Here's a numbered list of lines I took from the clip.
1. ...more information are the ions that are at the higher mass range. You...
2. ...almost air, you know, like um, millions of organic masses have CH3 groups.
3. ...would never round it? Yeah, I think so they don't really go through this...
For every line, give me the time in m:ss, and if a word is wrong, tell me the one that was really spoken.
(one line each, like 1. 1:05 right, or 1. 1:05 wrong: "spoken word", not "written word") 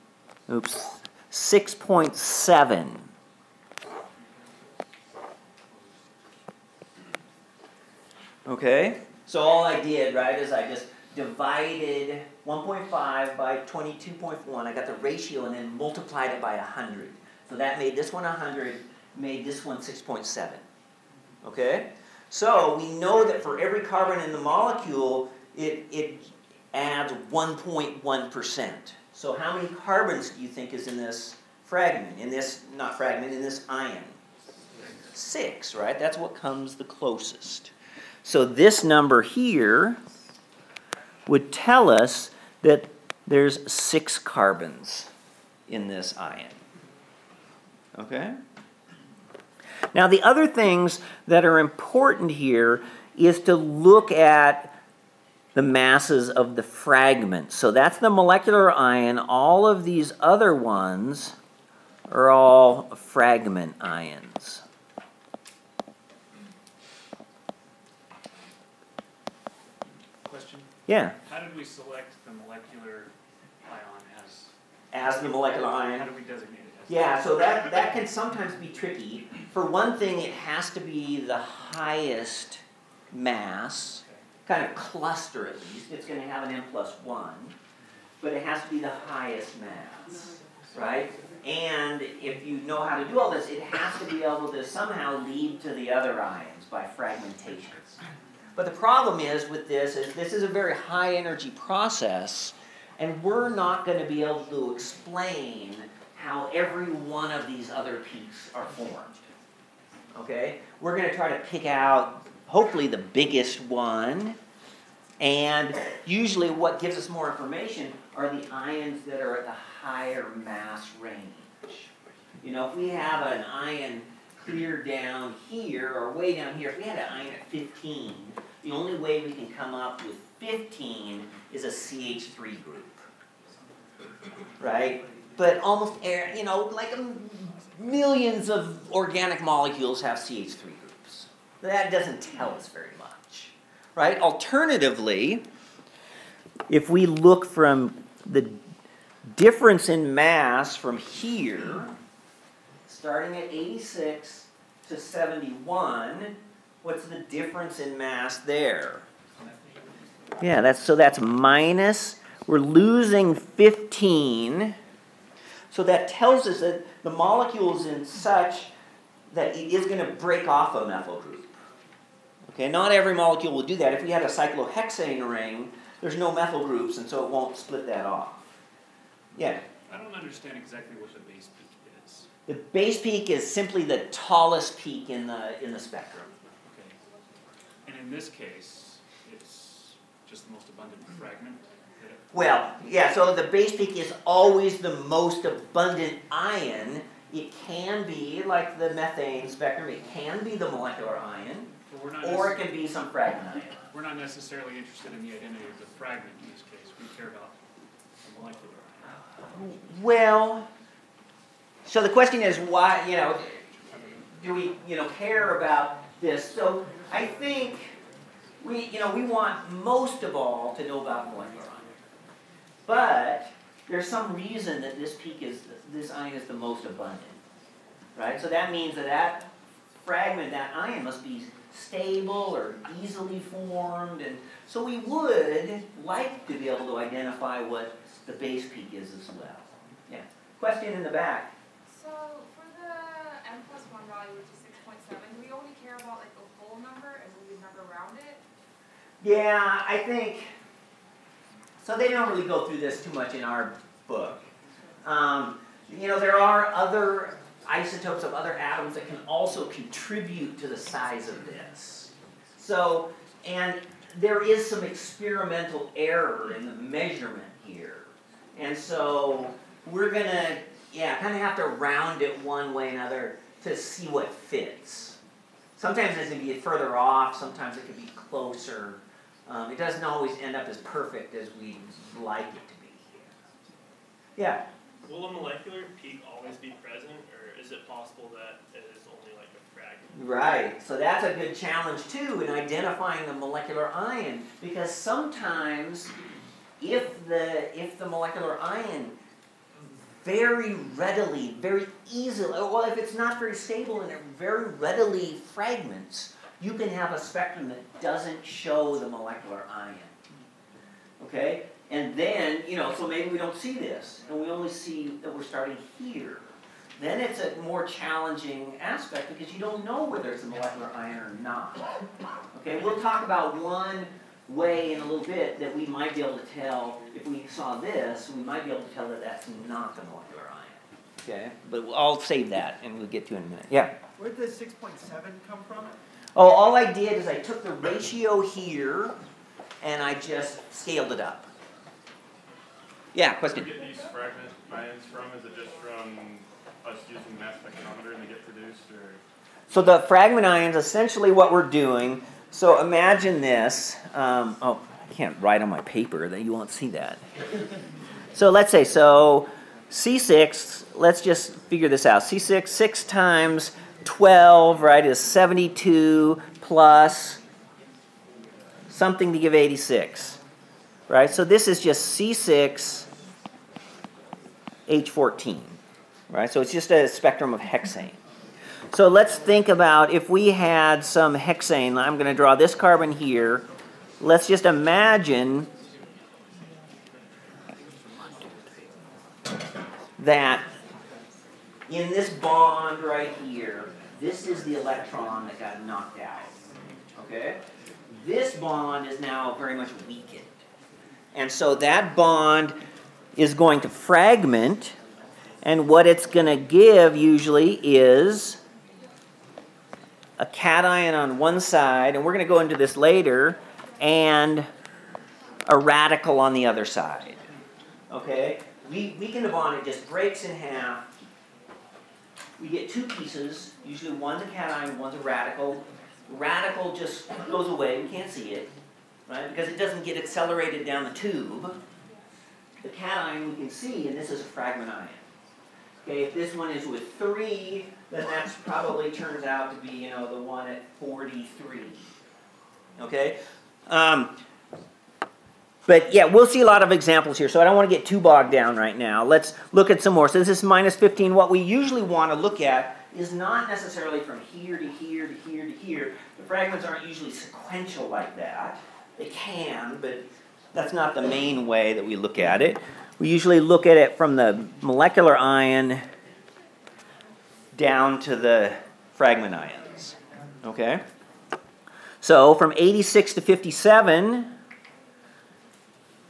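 1. 1:57 right
2. 2:15 wrong: "molecules", not "masses"
3. 4:07 right.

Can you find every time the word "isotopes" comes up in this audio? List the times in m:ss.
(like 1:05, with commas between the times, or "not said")
4:17.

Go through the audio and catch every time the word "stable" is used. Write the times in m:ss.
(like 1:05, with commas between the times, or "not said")
3:51, 5:03.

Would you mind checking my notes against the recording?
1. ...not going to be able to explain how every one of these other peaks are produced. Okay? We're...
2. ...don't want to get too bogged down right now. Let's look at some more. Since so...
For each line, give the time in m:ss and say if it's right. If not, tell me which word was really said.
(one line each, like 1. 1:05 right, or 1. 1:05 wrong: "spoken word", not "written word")
1. 1:43 wrong: "formed", not "produced"
2. 7:27 right.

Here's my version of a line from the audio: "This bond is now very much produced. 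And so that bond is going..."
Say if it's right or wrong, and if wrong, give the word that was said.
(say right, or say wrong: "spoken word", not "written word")
wrong: "weakened", not "produced".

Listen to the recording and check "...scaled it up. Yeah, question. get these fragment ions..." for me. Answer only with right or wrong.
right.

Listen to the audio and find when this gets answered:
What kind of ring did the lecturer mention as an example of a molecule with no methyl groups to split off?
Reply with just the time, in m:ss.
2:54.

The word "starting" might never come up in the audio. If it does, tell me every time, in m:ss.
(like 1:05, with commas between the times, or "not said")
2:32, 5:15.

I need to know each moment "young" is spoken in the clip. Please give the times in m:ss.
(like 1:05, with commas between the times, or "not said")
not said.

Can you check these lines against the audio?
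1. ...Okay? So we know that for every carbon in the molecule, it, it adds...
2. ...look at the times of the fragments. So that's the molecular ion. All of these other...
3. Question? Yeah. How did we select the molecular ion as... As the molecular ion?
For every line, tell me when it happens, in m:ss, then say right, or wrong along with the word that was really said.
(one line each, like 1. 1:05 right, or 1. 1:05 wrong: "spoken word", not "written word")
1. 0:21 right
2. 0:53 wrong: "masses", not "times"
3. 1:10 right.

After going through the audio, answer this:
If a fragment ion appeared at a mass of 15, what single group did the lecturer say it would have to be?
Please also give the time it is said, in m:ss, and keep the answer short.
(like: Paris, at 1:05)
CH3 group, at 2:11.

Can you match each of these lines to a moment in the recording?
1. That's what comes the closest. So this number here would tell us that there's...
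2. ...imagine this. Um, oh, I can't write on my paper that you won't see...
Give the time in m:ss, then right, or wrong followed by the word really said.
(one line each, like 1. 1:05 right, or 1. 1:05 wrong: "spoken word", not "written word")
1. 0:35 right
2. 5:52 right.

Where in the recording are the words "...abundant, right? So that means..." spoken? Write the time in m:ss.
3:46.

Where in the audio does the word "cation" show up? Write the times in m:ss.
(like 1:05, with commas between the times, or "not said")
6:50, 7:04, 7:12.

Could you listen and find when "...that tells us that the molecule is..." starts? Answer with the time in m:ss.
2:45.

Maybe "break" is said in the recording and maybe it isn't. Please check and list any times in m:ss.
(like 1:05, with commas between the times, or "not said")
2:50, 7:00.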